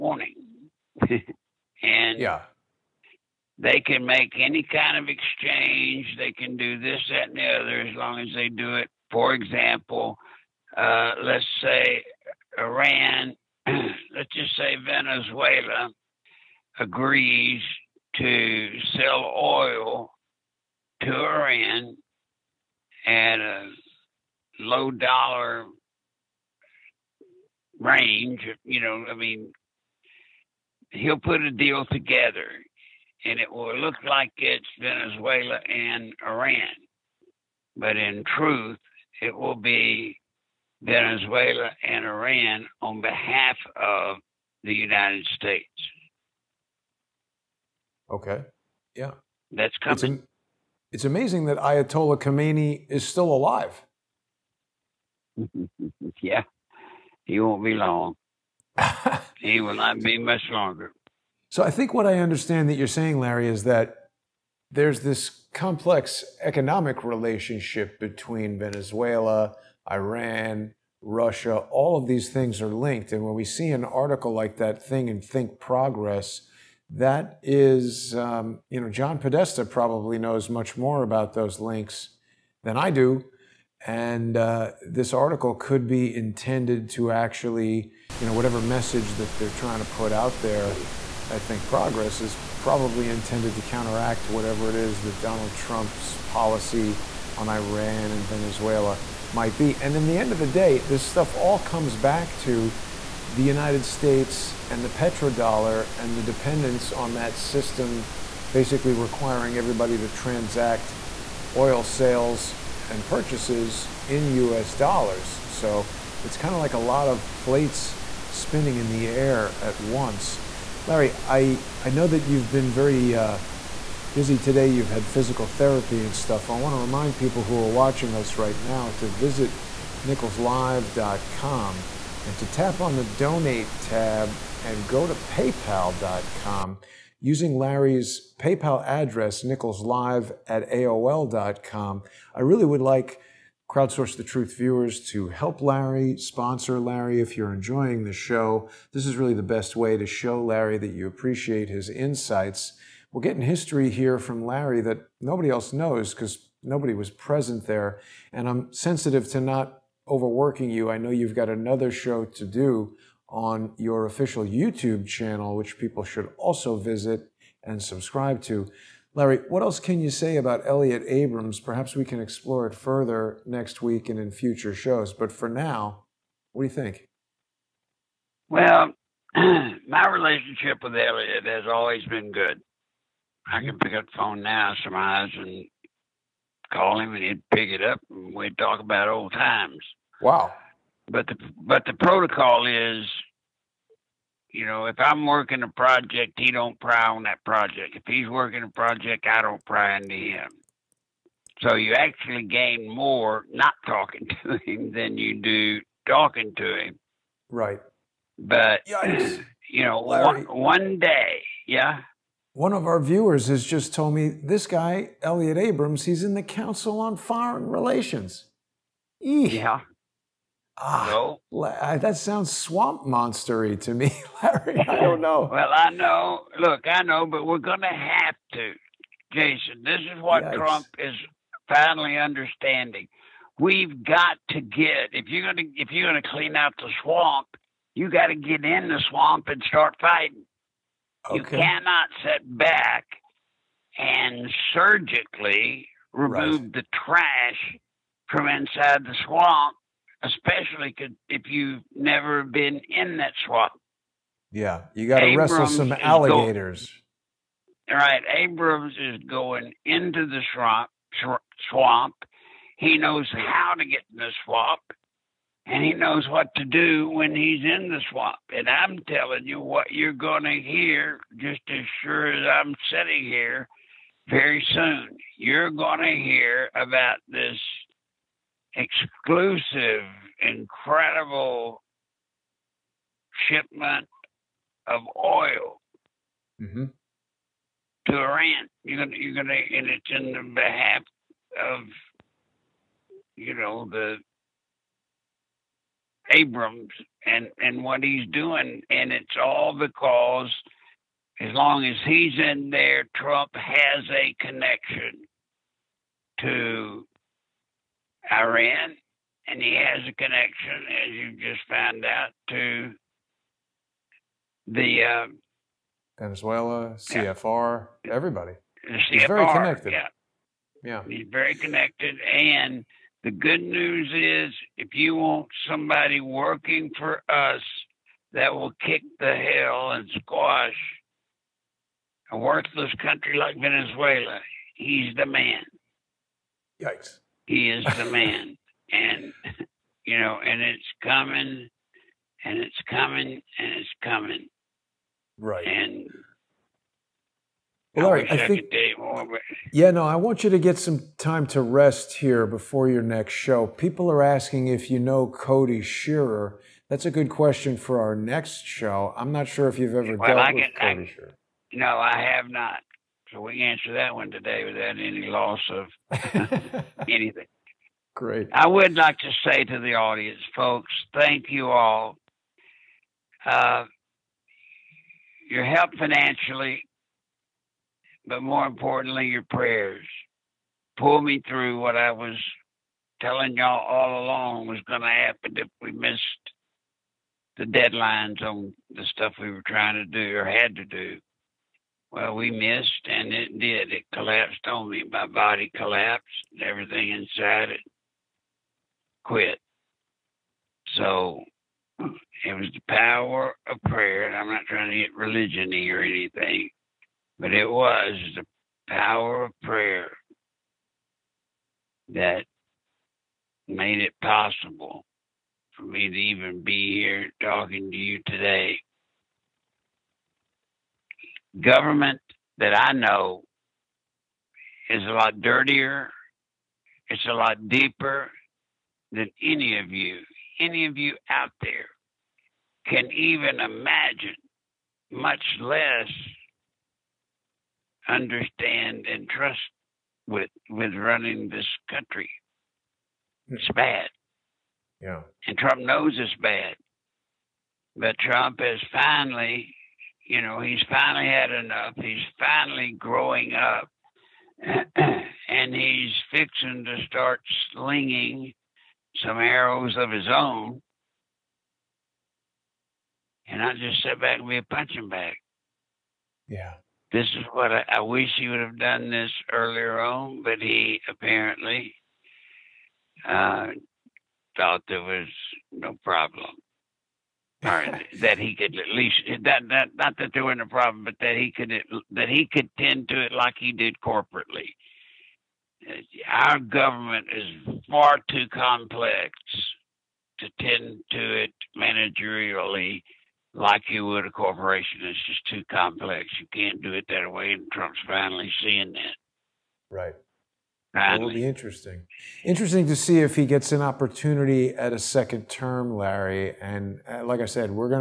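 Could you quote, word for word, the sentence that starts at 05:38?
and, you know, and it's coming and it's coming and it's coming.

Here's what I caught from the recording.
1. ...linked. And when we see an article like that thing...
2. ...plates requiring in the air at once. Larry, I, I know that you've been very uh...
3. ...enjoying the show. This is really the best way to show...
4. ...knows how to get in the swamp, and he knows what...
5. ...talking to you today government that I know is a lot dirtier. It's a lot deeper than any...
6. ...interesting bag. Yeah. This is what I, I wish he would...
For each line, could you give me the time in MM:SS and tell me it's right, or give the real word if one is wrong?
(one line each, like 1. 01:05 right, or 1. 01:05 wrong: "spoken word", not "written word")
1. 01:12 right
2. 01:57 wrong: "spinning", not "requiring"
3. 02:27 right
4. 04:22 right
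5. 06:57 right
6. 07:44 wrong: "punching", not "interesting".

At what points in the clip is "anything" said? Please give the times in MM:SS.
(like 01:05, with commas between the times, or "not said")
06:07, 06:46.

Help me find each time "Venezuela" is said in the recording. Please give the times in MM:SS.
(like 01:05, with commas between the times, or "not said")
00:14, 00:34, 00:40, 01:08, 01:38, 05:16, 05:33.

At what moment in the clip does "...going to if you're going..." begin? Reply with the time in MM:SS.
03:55.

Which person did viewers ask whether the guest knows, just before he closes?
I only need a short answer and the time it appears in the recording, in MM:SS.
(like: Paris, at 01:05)
Cody Shearer, at 05:55.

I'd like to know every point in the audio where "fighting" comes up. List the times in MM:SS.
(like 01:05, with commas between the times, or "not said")
03:59.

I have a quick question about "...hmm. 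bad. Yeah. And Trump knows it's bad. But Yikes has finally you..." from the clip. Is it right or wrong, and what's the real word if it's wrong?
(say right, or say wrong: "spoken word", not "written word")
wrong: "Trump", not "Yikes".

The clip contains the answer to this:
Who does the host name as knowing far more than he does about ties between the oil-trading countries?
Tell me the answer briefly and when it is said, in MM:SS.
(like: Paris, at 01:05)
John Podesta, at 01:18.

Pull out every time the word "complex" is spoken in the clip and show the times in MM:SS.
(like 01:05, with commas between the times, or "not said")
01:05, 08:08, 08:15.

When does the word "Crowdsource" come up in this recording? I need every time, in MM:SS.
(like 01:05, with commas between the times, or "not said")
02:23.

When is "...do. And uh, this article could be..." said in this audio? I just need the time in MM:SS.
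01:22.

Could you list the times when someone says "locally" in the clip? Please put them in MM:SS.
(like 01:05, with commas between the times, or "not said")
not said.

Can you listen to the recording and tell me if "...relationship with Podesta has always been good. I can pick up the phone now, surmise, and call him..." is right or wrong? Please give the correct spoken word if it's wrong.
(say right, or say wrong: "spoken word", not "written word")
wrong: "Elliot", not "Podesta".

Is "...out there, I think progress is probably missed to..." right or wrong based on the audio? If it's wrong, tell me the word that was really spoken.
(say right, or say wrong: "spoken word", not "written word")
wrong: "intended", not "missed".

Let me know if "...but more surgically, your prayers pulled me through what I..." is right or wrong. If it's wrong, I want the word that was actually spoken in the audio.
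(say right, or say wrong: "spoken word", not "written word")
wrong: "importantly", not "surgically".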